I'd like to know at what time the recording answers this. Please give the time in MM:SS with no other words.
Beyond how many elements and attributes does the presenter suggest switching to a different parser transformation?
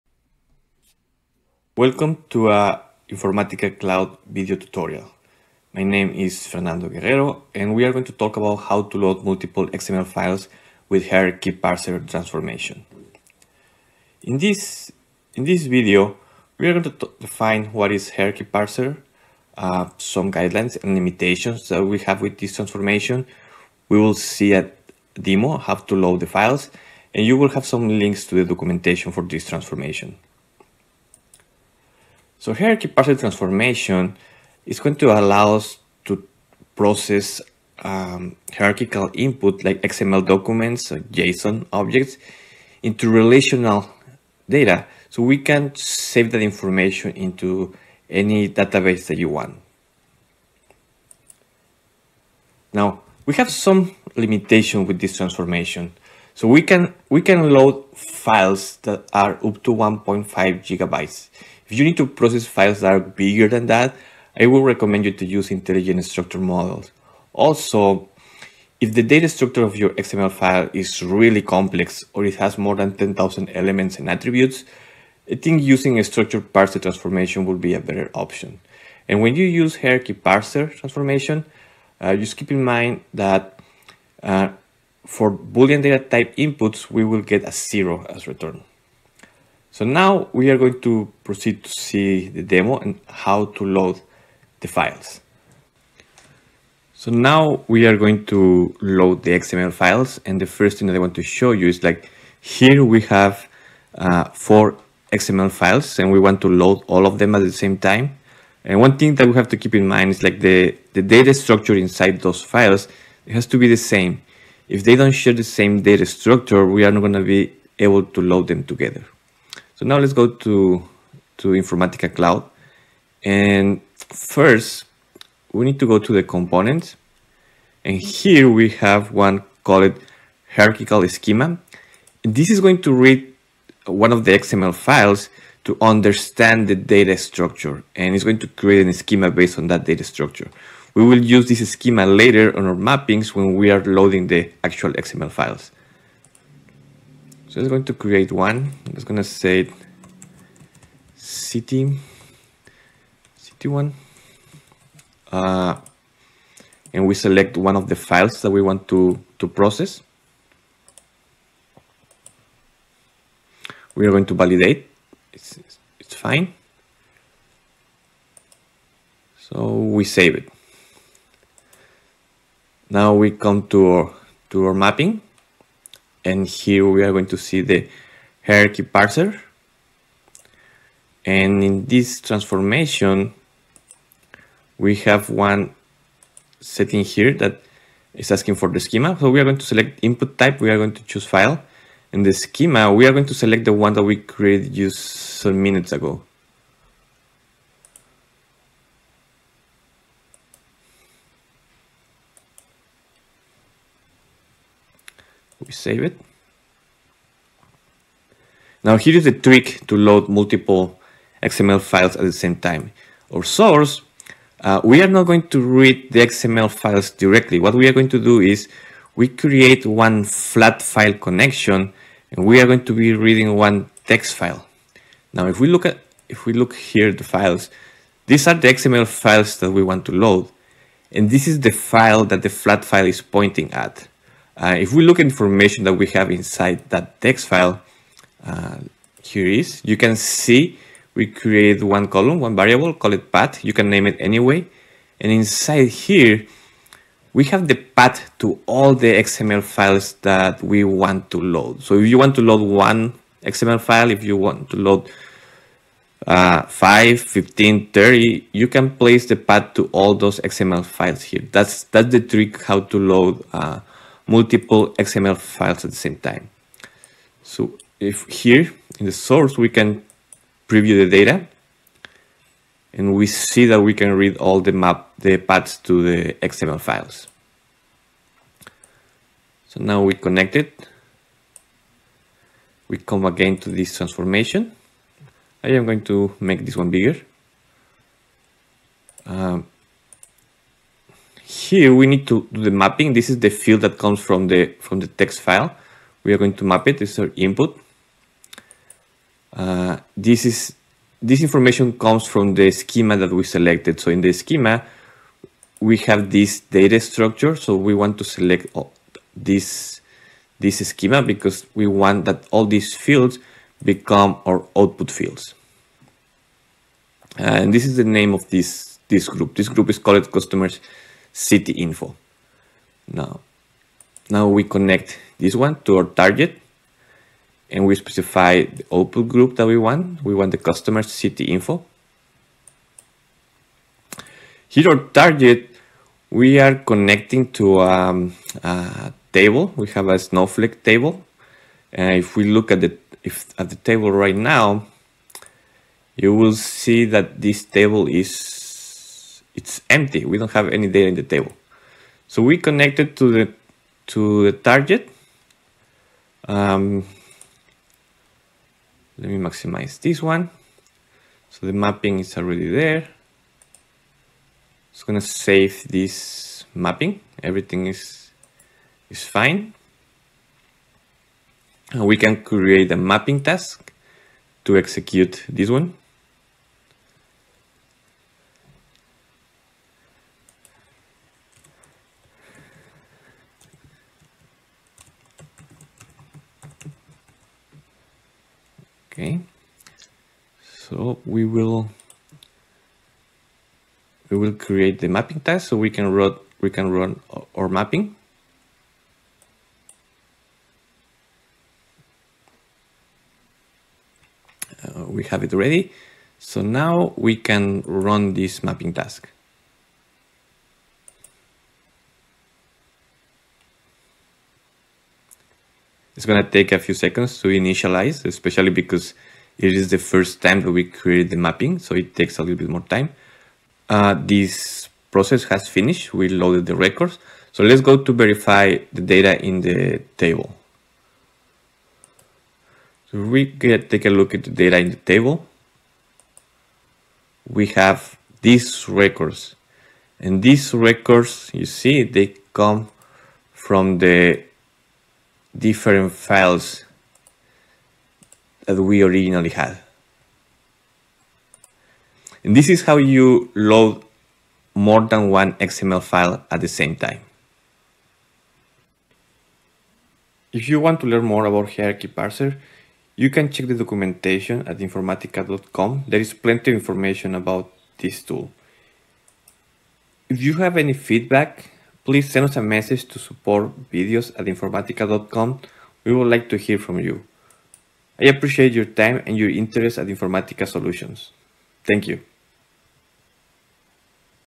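01:12.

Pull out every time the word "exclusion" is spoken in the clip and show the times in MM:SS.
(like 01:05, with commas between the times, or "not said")
not said.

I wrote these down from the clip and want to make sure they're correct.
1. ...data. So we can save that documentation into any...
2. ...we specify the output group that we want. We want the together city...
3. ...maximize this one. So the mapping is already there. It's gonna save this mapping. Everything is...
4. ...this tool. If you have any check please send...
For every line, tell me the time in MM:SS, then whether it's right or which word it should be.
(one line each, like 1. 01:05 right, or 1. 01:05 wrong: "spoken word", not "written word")
1. 00:44 wrong: "information", not "documentation"
2. 05:27 wrong: "customer", not "together"
3. 05:59 right
4. 07:47 wrong: "feedback", not "check".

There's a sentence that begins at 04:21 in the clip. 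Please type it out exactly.
That's that's the trick how to load uh, multiple XML files at the same time.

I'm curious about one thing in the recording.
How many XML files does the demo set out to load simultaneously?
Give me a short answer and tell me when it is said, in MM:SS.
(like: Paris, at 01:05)
4, at 01:44.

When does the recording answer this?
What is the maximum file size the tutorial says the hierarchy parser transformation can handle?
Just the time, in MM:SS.
00:59.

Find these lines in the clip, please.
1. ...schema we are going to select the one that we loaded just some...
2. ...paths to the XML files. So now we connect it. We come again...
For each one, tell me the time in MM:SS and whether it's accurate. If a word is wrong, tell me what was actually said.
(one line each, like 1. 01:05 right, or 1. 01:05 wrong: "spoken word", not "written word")
1. 03:12 wrong: "created", not "loaded"
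2. 04:35 right.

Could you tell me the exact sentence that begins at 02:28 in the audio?
I'm just going to say city, city one.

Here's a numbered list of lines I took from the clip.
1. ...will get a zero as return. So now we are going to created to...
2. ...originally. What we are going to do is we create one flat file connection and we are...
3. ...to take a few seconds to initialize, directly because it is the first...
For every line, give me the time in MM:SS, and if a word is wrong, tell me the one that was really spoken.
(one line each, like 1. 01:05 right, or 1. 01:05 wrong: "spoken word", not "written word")
1. 01:27 wrong: "proceed", not "created"
2. 03:37 wrong: "directly", not "originally"
3. 06:56 wrong: "especially", not "directly".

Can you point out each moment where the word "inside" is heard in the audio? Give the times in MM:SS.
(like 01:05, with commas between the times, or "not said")
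01:51, 03:56, 04:05.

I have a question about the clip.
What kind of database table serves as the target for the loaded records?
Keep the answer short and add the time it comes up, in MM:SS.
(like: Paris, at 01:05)
Snowflake, at 05:40.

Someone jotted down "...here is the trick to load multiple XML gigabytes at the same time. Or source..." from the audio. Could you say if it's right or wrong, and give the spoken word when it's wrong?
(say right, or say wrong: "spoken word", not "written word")
wrong: "files", not "gigabytes".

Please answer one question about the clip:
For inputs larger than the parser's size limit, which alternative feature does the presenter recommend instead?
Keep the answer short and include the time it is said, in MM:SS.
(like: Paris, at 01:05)
intelligent structure models, at 01:05.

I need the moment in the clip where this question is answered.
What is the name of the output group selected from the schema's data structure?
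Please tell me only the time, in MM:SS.
05:20.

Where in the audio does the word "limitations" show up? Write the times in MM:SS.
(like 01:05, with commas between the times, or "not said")
00:20, 00:54.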